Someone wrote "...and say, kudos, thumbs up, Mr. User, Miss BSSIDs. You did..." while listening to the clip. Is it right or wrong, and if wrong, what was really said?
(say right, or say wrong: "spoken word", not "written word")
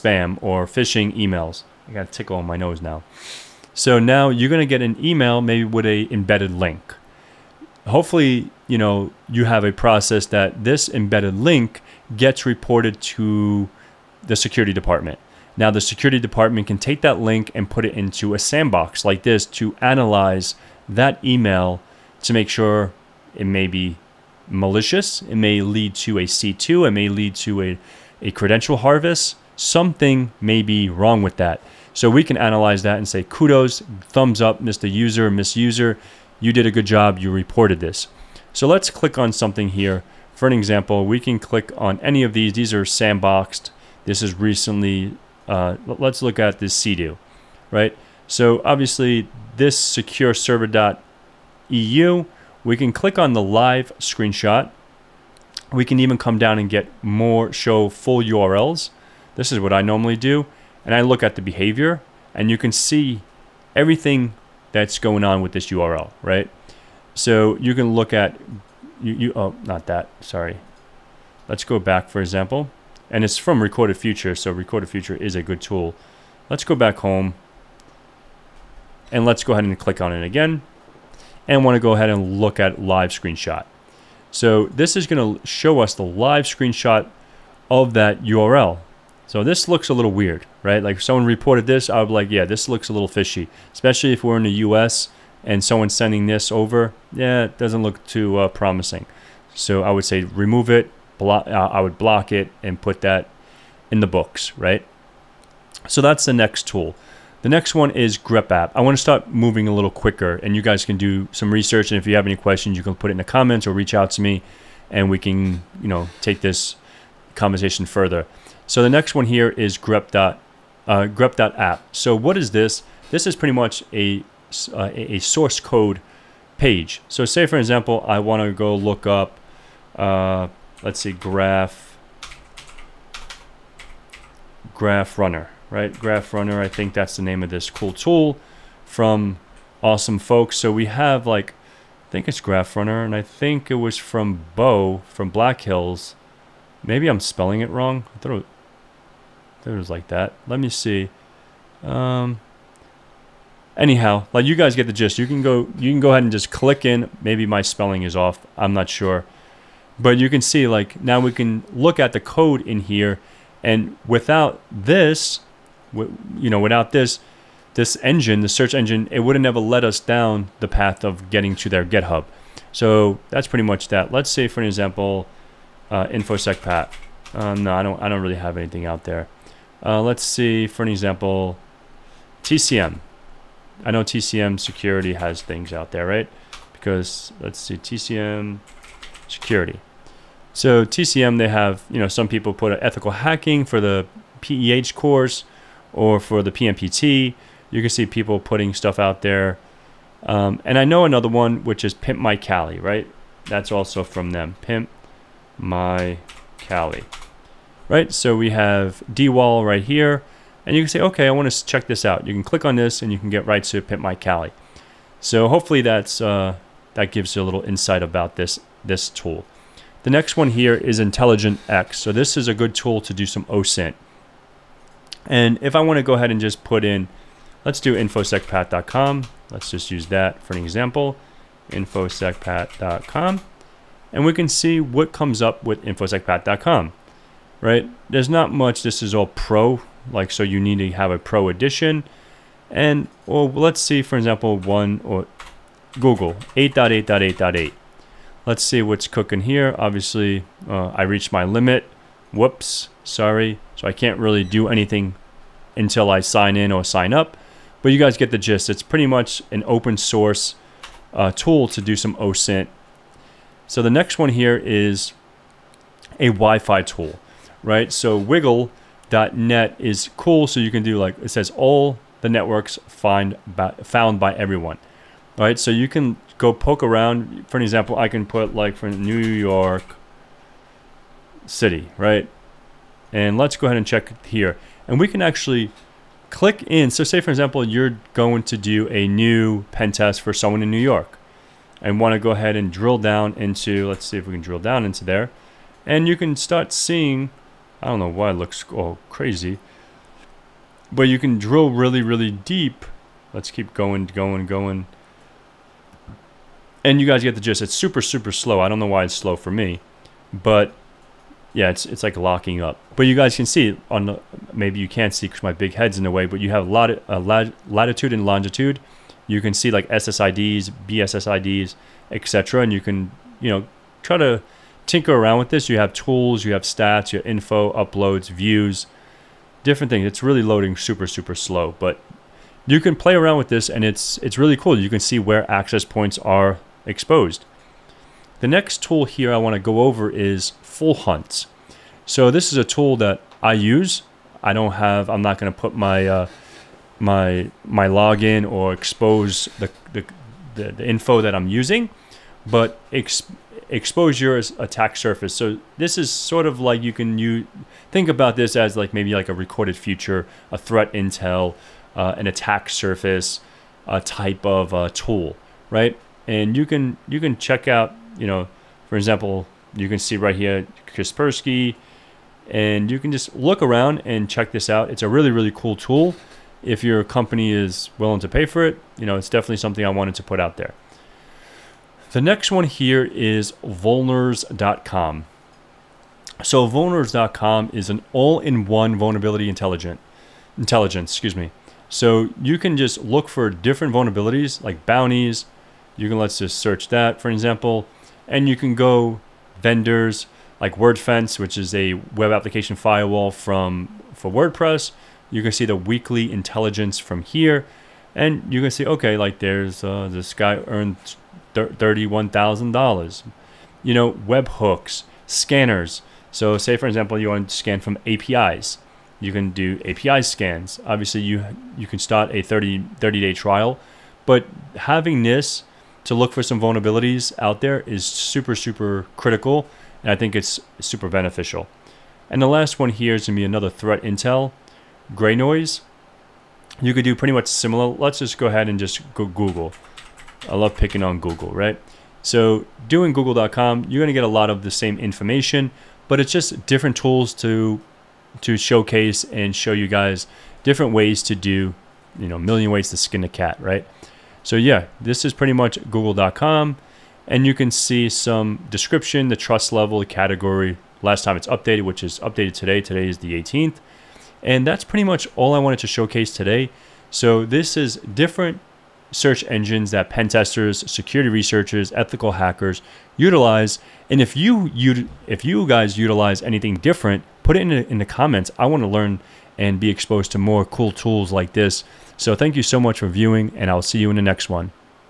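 wrong: "User", not "BSSIDs".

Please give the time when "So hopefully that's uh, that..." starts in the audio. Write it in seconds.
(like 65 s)
215 s.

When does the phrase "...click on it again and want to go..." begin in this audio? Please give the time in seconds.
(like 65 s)
79 s.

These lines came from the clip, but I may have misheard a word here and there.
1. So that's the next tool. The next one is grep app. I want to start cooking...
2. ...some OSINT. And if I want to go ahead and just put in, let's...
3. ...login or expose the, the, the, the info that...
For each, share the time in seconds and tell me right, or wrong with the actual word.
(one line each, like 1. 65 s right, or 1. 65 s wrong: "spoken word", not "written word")
1. 105 s wrong: "moving", not "cooking"
2. 223 s right
3. 347 s right.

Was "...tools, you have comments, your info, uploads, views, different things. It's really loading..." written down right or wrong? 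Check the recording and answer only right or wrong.
wrong.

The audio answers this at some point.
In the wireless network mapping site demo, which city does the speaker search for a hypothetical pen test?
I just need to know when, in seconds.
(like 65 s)
278 s.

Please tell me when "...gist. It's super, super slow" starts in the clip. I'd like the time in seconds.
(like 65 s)
307 s.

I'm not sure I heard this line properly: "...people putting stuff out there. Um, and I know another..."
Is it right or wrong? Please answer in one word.
right.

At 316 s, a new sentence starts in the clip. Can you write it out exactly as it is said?
But you have a uh, lat latitude and longitude.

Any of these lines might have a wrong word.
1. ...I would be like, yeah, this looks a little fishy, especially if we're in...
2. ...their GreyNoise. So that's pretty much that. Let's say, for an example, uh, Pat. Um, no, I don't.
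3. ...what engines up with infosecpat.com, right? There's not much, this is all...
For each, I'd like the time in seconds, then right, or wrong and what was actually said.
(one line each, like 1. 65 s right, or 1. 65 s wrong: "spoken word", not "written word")
1. 91 s right
2. 171 s wrong: "GitHub", not "GreyNoise"
3. 234 s wrong: "comes", not "engines".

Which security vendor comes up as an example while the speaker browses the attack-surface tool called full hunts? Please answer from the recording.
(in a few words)
Kaspersky.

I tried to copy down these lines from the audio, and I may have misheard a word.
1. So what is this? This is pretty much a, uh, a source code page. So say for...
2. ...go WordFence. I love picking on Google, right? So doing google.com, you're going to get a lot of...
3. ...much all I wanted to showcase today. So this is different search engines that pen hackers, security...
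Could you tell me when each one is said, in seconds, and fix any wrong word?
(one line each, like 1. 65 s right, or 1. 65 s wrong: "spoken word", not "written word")
1. 121 s right
2. 439 s wrong: "Google", not "WordFence"
3. 465 s wrong: "testers", not "hackers".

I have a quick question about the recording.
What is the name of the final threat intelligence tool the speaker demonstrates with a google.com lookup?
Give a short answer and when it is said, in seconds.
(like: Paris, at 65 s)
GreyNoise, at 435 s.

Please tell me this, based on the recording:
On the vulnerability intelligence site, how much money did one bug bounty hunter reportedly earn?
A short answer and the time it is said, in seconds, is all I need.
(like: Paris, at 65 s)
$31,000, at 411 s.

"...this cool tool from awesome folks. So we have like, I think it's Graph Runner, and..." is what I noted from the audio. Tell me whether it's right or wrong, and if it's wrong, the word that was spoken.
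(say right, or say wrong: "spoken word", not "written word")
right.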